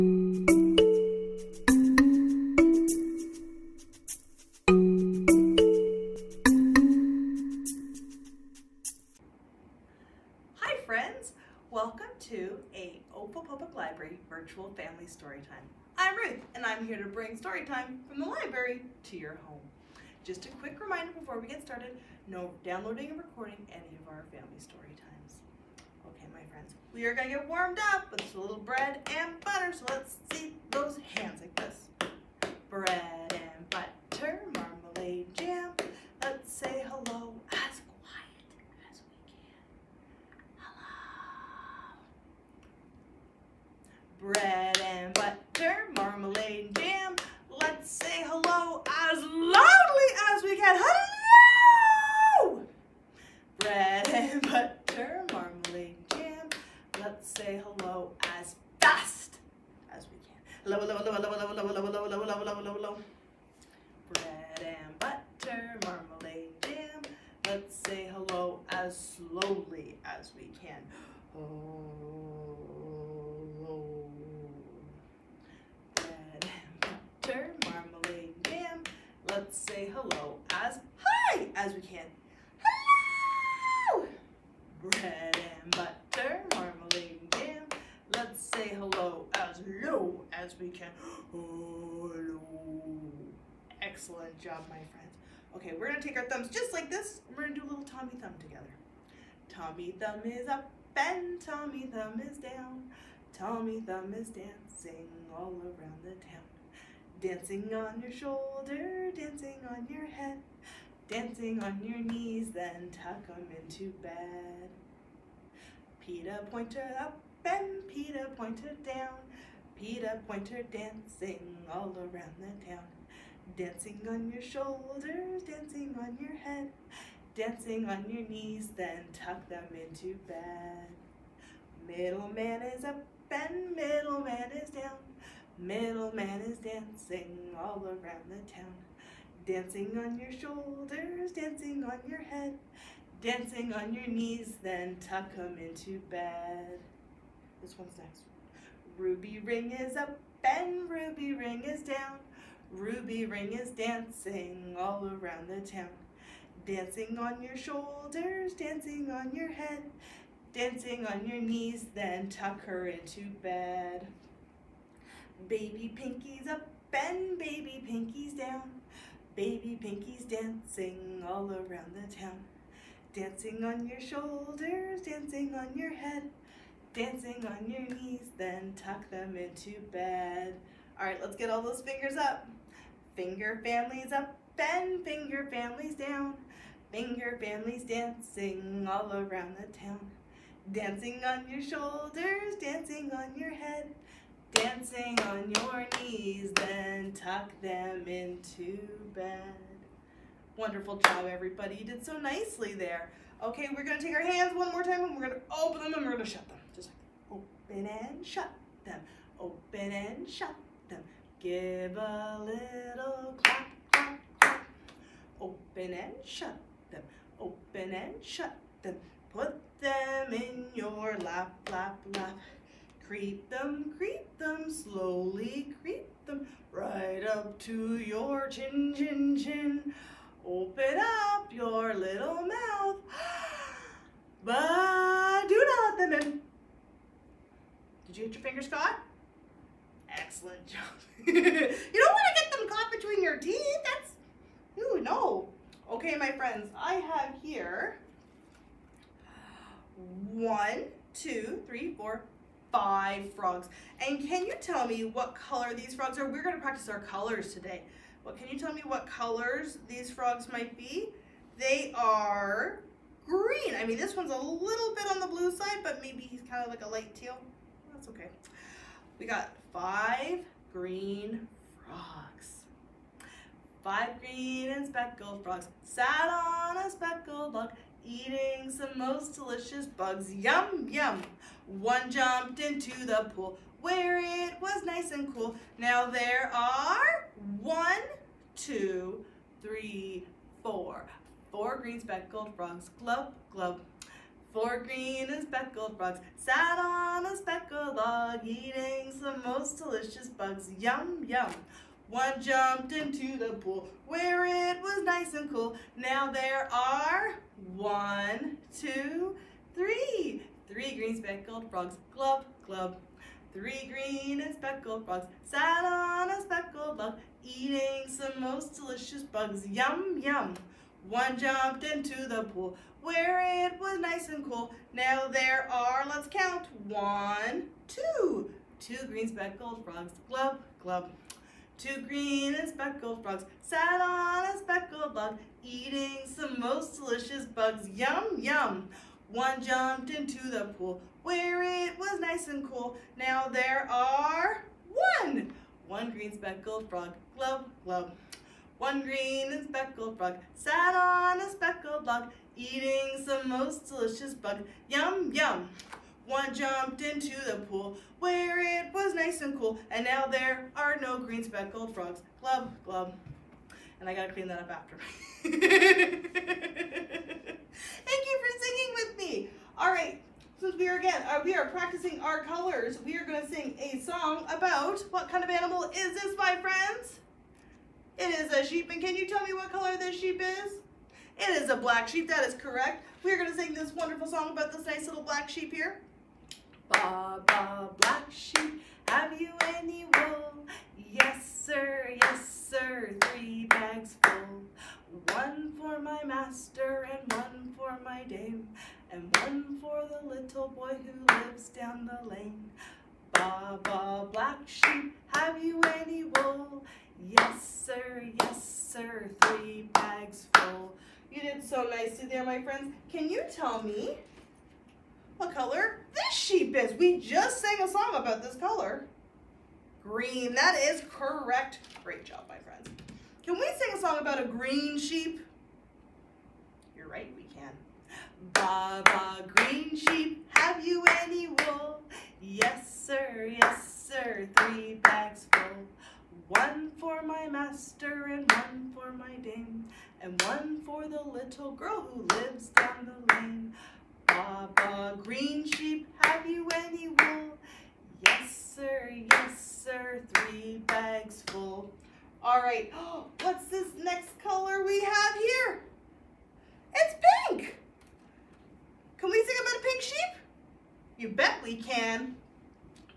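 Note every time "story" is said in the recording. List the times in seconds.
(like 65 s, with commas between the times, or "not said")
17 s, 24 s.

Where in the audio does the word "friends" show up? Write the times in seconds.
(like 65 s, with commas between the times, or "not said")
26 s, 94 s, 246 s, 376 s, 412 s, 422 s.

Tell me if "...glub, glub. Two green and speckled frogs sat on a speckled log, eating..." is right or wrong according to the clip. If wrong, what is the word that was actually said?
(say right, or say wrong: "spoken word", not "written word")
wrong: "Three", not "Two".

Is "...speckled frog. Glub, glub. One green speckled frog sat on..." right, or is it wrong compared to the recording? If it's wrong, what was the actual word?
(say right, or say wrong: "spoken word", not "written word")
right.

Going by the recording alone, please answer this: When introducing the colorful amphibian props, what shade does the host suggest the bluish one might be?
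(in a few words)
Light teal.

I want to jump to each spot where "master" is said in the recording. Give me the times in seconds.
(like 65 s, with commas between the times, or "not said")
396 s, 437 s.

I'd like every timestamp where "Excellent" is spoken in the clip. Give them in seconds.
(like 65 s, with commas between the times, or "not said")
93 s, 240 s.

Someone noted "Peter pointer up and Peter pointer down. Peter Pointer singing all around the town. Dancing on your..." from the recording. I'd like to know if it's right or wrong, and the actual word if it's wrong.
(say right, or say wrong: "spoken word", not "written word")
wrong: "dancing", not "singing".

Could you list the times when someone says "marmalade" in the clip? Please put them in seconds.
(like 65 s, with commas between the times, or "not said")
65 s, 77 s.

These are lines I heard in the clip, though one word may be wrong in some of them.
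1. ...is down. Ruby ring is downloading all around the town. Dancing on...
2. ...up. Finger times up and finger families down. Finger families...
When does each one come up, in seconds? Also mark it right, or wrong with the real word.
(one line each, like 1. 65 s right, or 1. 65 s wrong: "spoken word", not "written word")
1. 151 s wrong: "dancing", not "downloading"
2. 182 s wrong: "families", not "times".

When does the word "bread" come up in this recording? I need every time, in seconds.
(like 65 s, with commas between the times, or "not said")
28 s, 32 s, 64 s, 75 s, 84 s.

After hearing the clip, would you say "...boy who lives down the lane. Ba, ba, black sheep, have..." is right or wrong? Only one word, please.
right.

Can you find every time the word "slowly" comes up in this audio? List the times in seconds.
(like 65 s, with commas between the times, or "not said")
69 s, 224 s.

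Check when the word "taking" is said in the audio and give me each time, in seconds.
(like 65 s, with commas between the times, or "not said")
not said.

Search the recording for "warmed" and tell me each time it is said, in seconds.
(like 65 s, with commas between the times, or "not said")
27 s.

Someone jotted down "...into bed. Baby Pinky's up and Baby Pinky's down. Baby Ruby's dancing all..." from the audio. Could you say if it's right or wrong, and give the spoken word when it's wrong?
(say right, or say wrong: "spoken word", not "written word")
wrong: "Pinky", not "Ruby".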